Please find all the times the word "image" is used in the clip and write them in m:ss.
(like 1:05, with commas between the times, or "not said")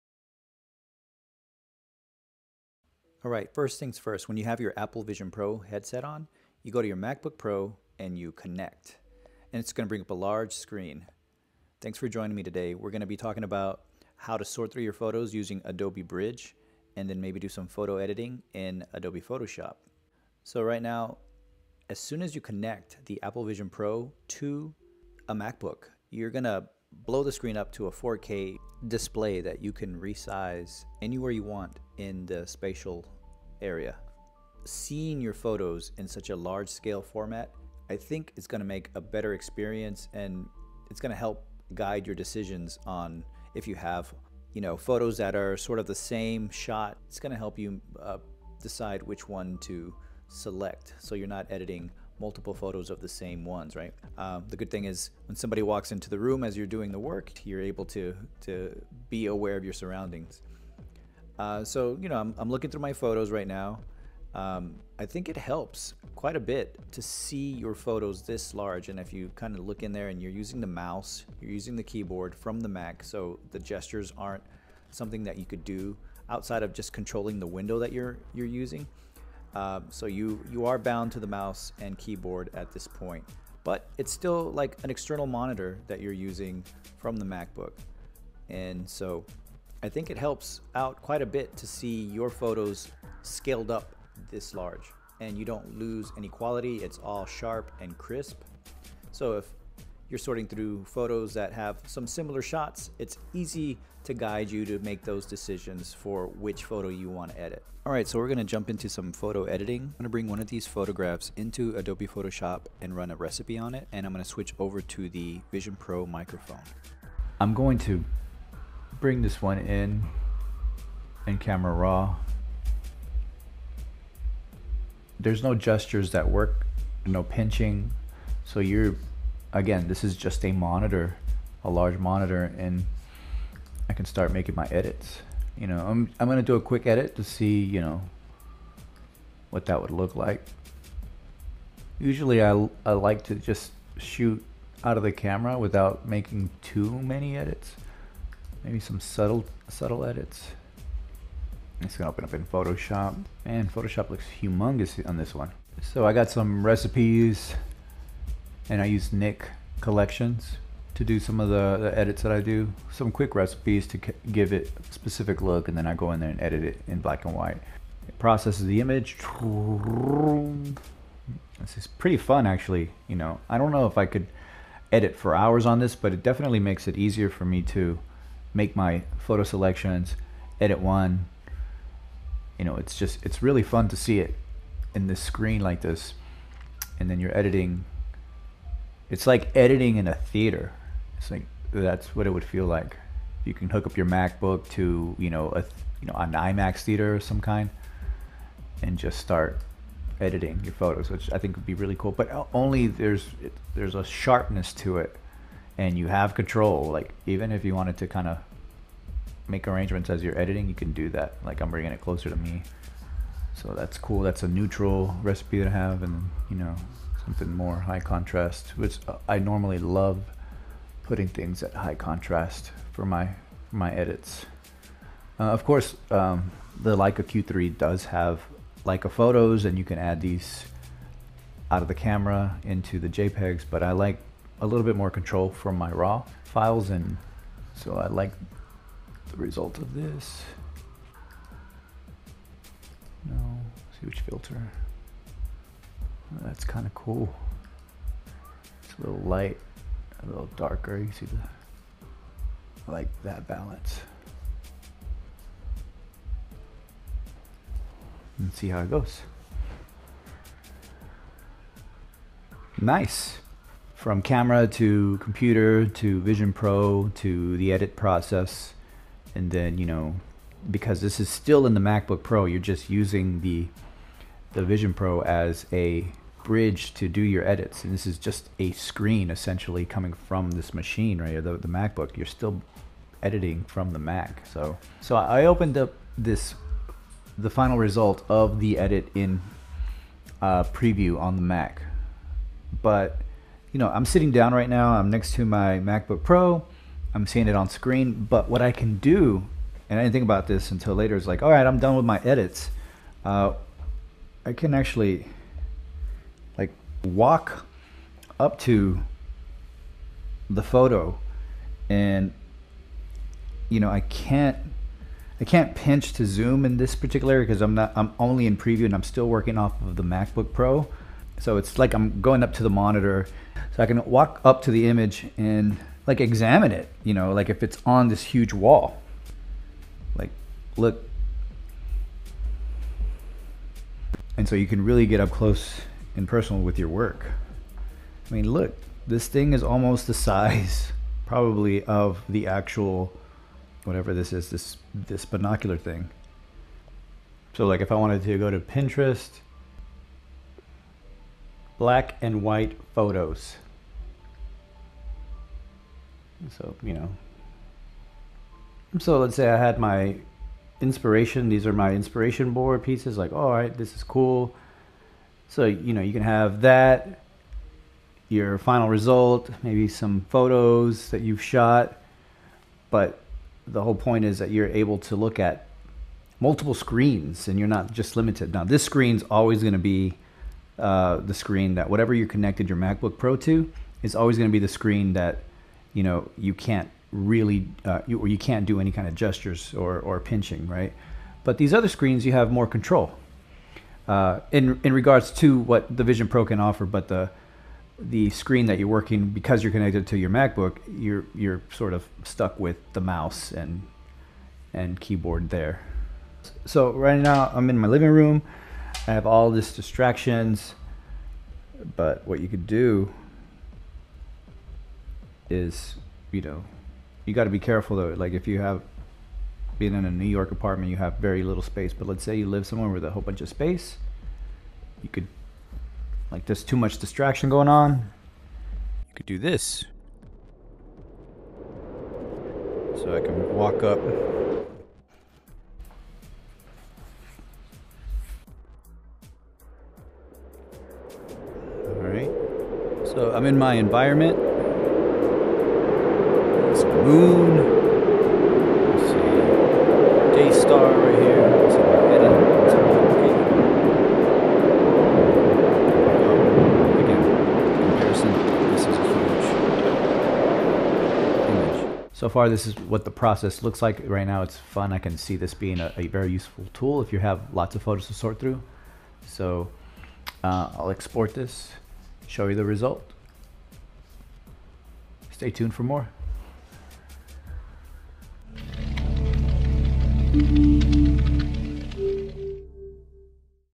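2:48, 5:24.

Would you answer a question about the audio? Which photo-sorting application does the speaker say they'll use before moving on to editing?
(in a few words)
Adobe Bridge.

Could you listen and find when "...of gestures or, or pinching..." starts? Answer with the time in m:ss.
6:29.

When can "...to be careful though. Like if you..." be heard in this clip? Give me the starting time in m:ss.
6:57.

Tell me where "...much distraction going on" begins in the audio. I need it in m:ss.
7:06.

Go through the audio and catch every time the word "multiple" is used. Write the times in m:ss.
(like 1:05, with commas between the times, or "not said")
0:52, 6:16.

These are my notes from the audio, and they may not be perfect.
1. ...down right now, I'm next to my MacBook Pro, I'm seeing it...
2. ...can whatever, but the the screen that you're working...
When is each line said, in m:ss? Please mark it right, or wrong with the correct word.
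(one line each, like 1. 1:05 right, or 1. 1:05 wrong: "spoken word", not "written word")
1. 4:54 right
2. 6:36 wrong: "offer", not "whatever".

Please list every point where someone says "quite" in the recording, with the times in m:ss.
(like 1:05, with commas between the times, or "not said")
1:06, 1:31.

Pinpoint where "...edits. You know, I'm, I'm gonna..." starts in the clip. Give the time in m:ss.
2:14.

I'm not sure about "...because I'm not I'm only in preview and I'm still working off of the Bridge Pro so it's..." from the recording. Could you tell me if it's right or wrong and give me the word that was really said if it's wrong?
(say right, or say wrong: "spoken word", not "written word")
wrong: "MacBook", not "Bridge".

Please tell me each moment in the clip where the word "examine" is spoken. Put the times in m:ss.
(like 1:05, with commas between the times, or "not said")
5:26.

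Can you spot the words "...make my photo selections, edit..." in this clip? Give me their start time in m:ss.
2:58.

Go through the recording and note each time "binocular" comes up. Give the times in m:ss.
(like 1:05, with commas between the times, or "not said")
5:45.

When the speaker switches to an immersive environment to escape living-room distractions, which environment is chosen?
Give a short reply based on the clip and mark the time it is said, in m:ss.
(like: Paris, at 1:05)
Moon, at 7:26.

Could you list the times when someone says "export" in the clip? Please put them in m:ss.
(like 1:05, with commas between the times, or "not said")
7:50.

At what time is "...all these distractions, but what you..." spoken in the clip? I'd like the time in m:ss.
6:49.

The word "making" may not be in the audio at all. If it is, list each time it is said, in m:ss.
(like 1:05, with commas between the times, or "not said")
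2:14, 2:26.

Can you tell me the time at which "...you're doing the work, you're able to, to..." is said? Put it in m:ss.
0:56.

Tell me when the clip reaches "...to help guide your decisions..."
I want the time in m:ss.
0:41.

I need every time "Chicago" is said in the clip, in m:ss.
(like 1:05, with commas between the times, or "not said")
not said.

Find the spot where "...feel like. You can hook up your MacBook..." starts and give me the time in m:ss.
3:12.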